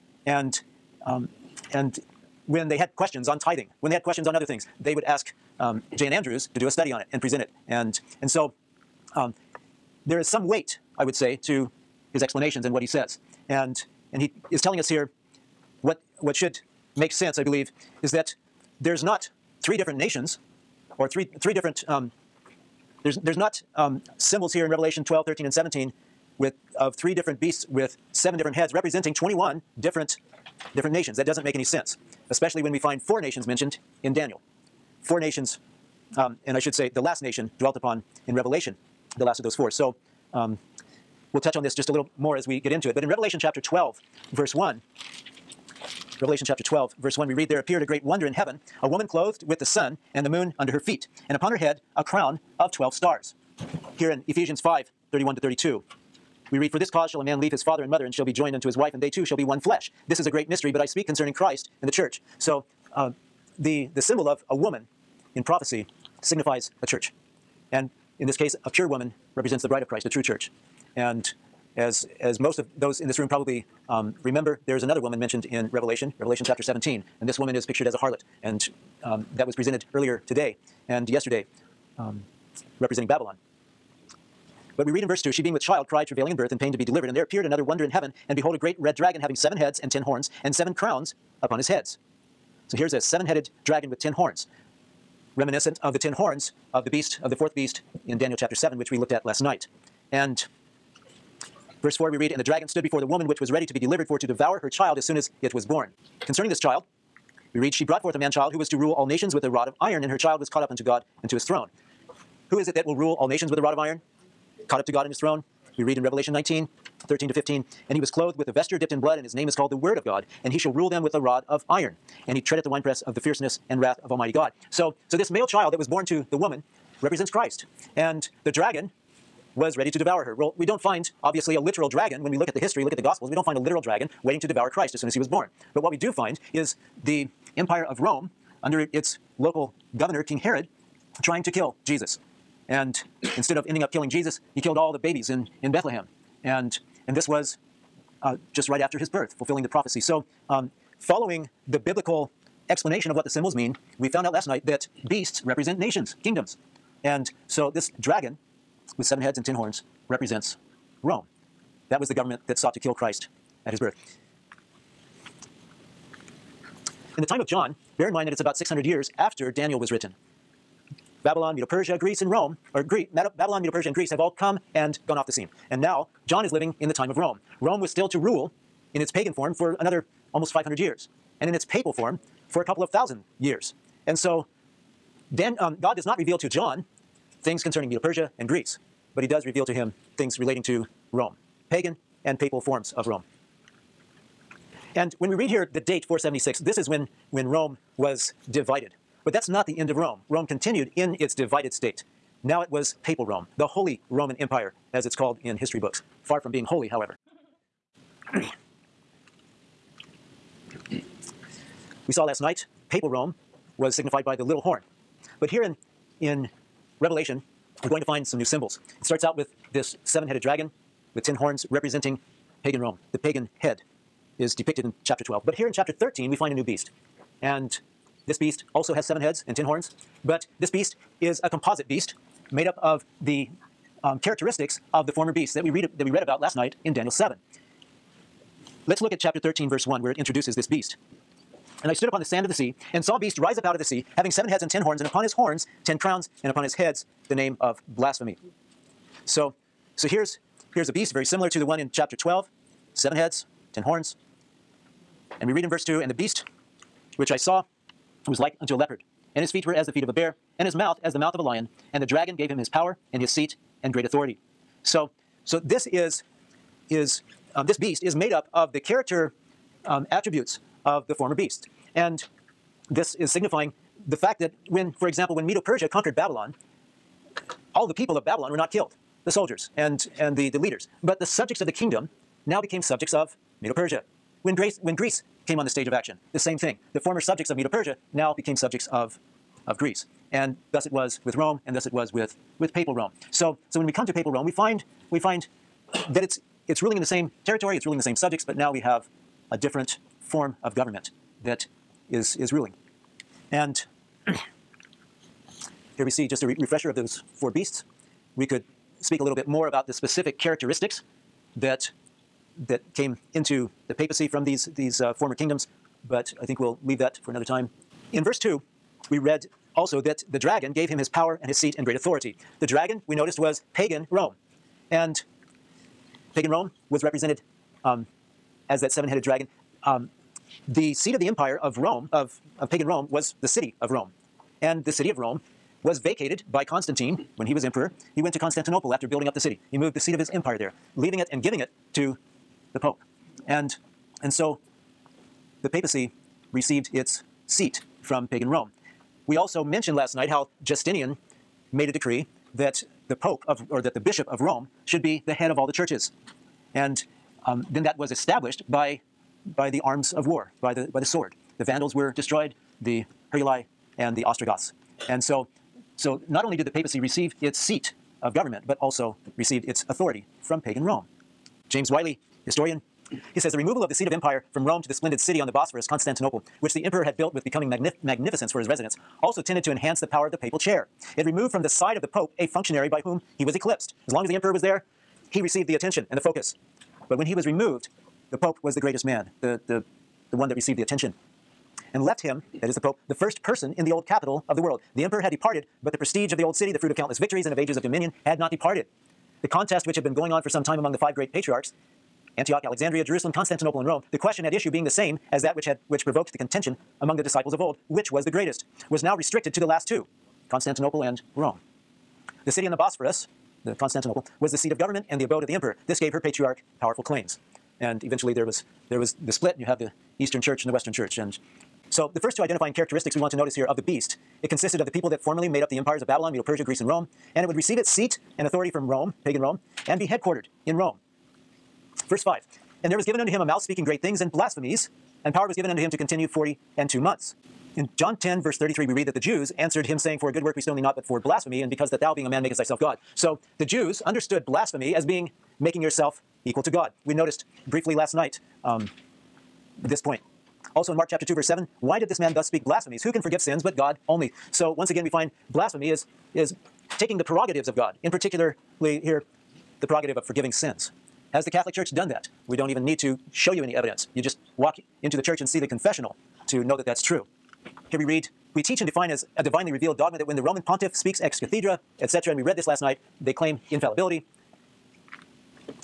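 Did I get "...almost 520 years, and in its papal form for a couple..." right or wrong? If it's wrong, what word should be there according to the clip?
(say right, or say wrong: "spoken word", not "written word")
wrong: "500", not "520".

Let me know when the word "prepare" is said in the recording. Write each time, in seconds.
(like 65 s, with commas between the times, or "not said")
not said.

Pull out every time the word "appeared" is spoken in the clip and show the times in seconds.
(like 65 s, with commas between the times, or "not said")
47 s, 87 s.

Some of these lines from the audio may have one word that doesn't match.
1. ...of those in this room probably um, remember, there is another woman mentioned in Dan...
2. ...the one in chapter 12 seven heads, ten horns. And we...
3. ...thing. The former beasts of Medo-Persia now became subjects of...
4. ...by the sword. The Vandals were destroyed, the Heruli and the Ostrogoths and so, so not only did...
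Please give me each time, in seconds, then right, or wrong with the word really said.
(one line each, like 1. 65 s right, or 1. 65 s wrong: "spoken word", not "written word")
1. 72 s wrong: "Revelation", not "Dan"
2. 251 s right
3. 286 s wrong: "subjects", not "beasts"
4. 360 s right.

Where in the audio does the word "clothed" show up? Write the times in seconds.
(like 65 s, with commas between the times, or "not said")
49 s, 118 s.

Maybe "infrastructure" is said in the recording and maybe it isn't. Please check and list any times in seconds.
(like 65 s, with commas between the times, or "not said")
not said.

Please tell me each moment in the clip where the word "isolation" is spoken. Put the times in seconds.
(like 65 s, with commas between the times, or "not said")
not said.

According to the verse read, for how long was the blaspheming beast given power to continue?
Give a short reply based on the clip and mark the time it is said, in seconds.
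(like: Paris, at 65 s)
42 months, at 436 s.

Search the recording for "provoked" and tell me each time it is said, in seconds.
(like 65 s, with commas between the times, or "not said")
406 s.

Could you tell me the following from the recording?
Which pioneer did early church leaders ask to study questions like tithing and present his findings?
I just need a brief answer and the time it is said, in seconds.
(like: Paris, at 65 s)
J.N. Andrews, at 5 s.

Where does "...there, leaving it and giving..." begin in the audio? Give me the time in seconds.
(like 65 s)
340 s.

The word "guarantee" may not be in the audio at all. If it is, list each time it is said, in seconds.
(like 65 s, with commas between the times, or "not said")
not said.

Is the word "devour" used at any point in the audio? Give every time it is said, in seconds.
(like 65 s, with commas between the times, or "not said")
104 s, 129 s, 134 s.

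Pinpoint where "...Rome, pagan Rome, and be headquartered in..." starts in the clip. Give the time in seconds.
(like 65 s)
428 s.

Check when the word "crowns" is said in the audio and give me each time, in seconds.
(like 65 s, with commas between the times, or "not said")
52 s, 90 s, 245 s.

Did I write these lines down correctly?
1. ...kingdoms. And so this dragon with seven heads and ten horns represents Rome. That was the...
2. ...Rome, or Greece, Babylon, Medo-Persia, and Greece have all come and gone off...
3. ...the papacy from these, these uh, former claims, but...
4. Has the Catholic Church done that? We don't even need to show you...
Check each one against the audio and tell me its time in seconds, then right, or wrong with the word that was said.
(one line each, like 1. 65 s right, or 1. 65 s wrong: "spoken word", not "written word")
1. 156 s right
2. 172 s right
3. 313 s wrong: "kingdoms", not "claims"
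4. 461 s right.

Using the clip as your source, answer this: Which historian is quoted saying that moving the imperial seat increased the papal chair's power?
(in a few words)
James Wylie.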